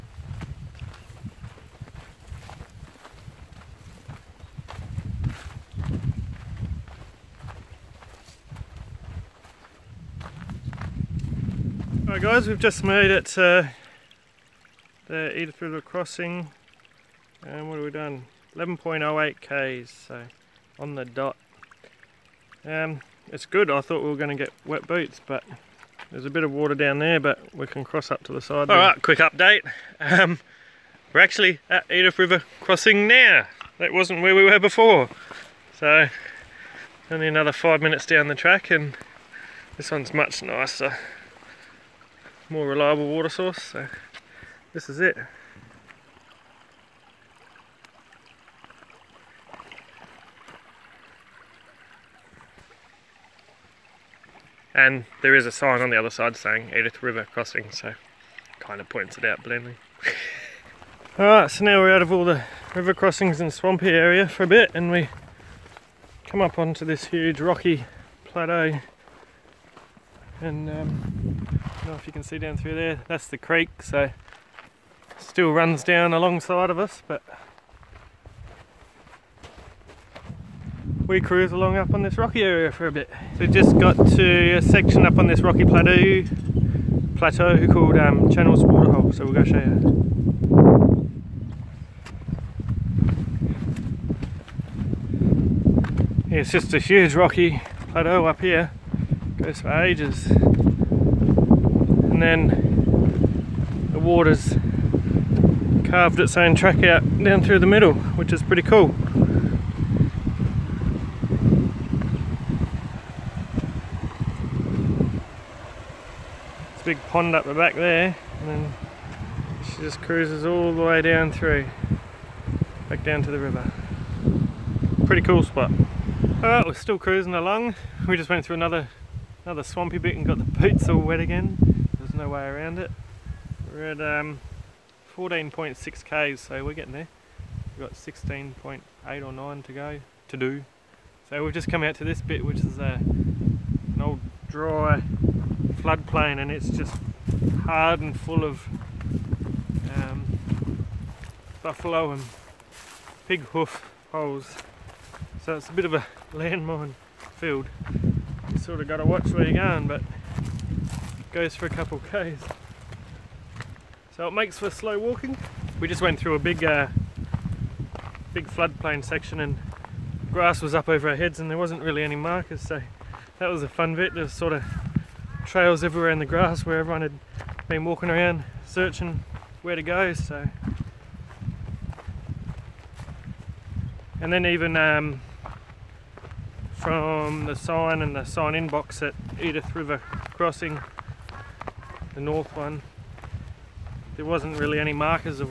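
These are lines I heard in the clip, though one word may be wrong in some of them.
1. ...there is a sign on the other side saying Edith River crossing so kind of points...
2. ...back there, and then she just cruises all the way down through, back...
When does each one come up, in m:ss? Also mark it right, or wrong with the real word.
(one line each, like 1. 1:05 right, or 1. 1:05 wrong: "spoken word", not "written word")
1. 0:55 right
2. 1:57 right.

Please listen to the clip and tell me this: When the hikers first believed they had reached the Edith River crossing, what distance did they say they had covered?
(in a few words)
11.08 km.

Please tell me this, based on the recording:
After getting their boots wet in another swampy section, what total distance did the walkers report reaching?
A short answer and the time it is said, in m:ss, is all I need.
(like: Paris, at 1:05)
14.6 km, at 2:15.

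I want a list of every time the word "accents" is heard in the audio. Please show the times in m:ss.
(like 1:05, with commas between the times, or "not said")
not said.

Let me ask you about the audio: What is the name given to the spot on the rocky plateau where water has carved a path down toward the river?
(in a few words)
Channels Waterhole.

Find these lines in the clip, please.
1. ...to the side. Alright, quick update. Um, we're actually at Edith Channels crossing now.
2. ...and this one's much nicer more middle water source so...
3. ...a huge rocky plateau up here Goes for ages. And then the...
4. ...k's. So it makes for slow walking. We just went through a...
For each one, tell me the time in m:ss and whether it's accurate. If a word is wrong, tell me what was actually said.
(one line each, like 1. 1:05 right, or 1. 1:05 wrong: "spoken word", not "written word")
1. 0:28 wrong: "River", not "Channels"
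2. 0:38 wrong: "reliable", not "middle"
3. 1:36 right
4. 2:42 right.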